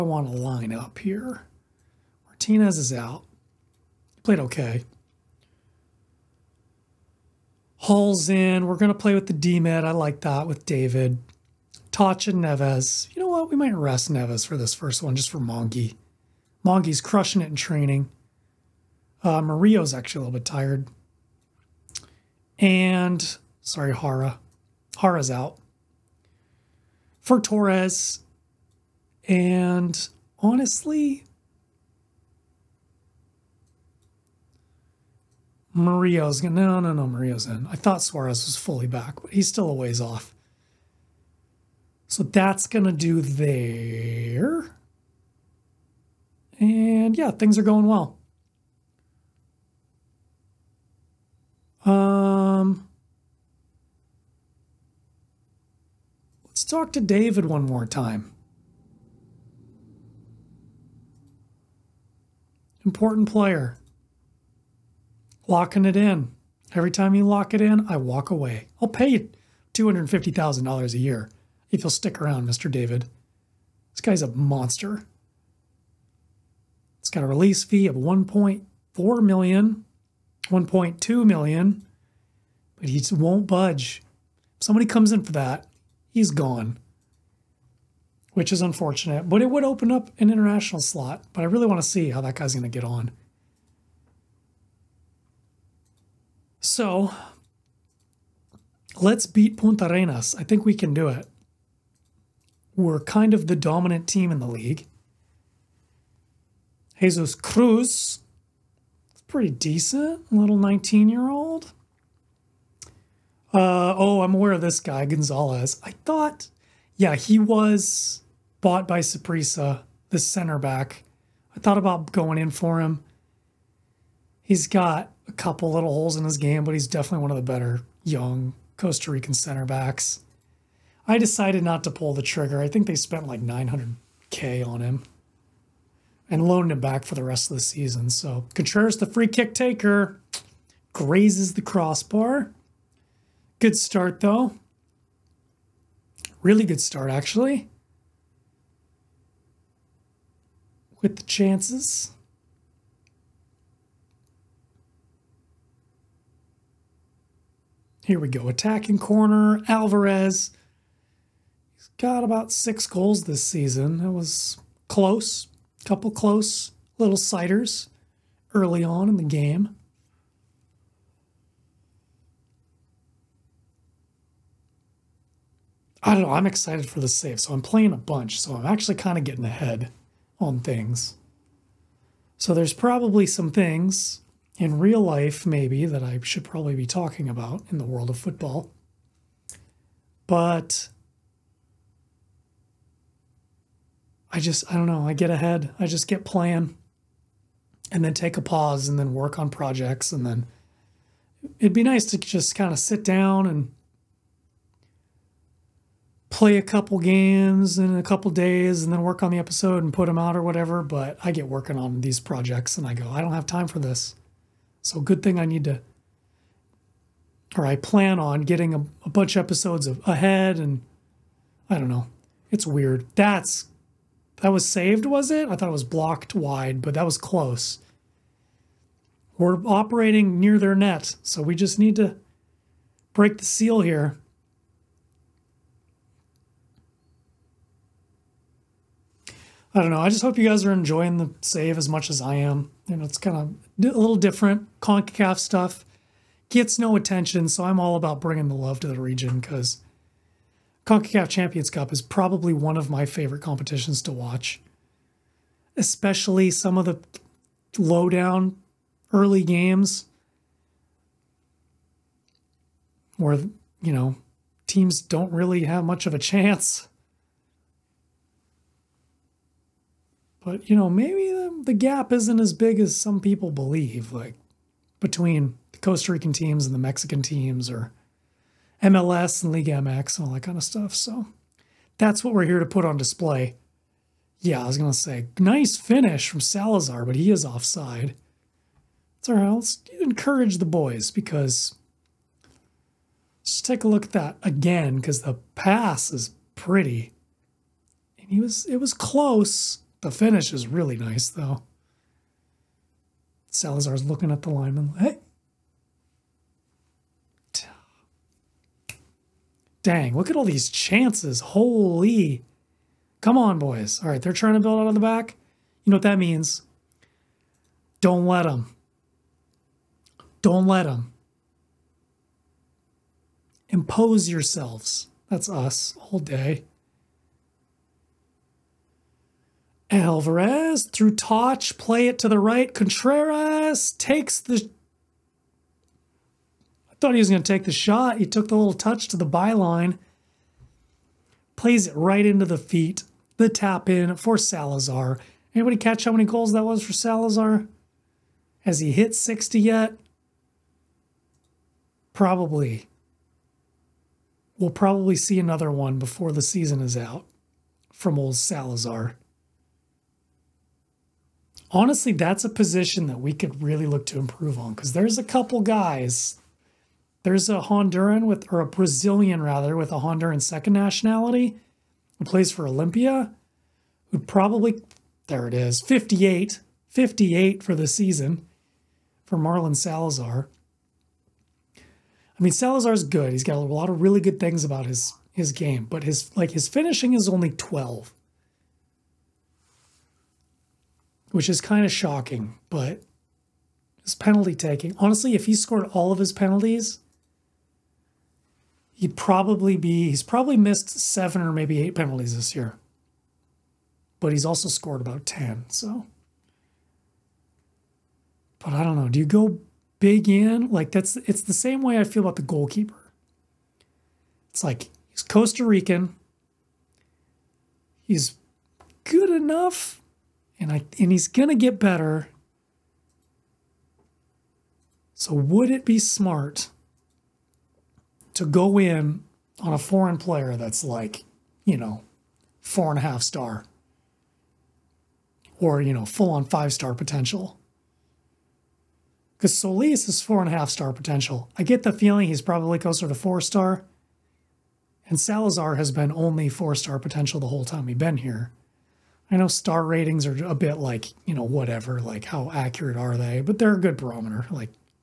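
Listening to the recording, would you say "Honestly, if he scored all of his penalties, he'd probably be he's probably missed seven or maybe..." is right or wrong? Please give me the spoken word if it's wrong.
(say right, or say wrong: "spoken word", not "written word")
right.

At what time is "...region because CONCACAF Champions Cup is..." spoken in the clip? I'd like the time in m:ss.
4:08.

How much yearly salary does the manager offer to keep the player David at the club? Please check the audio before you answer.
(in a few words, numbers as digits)
$250,000.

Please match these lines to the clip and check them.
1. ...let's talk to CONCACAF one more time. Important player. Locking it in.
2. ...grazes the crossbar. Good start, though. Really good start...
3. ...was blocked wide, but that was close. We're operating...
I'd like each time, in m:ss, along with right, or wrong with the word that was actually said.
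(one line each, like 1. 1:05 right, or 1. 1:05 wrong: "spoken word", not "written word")
1. 0:56 wrong: "David", not "CONCACAF"
2. 2:20 right
3. 3:45 right.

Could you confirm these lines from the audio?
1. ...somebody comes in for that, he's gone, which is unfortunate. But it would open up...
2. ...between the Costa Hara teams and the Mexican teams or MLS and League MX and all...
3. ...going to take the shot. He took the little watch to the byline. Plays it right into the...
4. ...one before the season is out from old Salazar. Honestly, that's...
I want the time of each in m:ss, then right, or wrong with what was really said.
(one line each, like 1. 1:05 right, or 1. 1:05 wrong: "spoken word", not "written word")
1. 1:24 right
2. 4:34 wrong: "Rican", not "Hara"
3. 5:37 wrong: "touch", not "watch"
4. 5:55 right.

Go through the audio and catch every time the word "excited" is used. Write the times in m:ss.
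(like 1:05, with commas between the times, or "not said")
2:56.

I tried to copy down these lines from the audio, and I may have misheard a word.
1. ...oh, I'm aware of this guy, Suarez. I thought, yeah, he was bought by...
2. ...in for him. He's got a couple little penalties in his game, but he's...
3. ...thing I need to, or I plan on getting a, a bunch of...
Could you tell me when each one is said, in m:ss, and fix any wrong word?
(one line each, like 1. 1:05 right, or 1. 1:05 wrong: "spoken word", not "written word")
1. 1:53 wrong: "Gonzalez", not "Suarez"
2. 2:02 wrong: "holes", not "penalties"
3. 3:35 right.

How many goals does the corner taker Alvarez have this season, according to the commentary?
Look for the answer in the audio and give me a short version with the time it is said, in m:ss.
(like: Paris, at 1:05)
6, at 2:42.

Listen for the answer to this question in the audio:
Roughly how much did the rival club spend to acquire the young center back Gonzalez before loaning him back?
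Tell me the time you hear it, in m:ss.
2:13.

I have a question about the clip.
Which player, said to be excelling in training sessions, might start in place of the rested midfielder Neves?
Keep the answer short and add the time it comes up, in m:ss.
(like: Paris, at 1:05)
Mongi, at 0:16.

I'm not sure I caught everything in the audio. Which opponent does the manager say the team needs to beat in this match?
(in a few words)
Puntarenas.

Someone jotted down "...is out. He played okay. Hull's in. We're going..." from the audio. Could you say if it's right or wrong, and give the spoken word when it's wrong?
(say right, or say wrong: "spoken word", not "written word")
right.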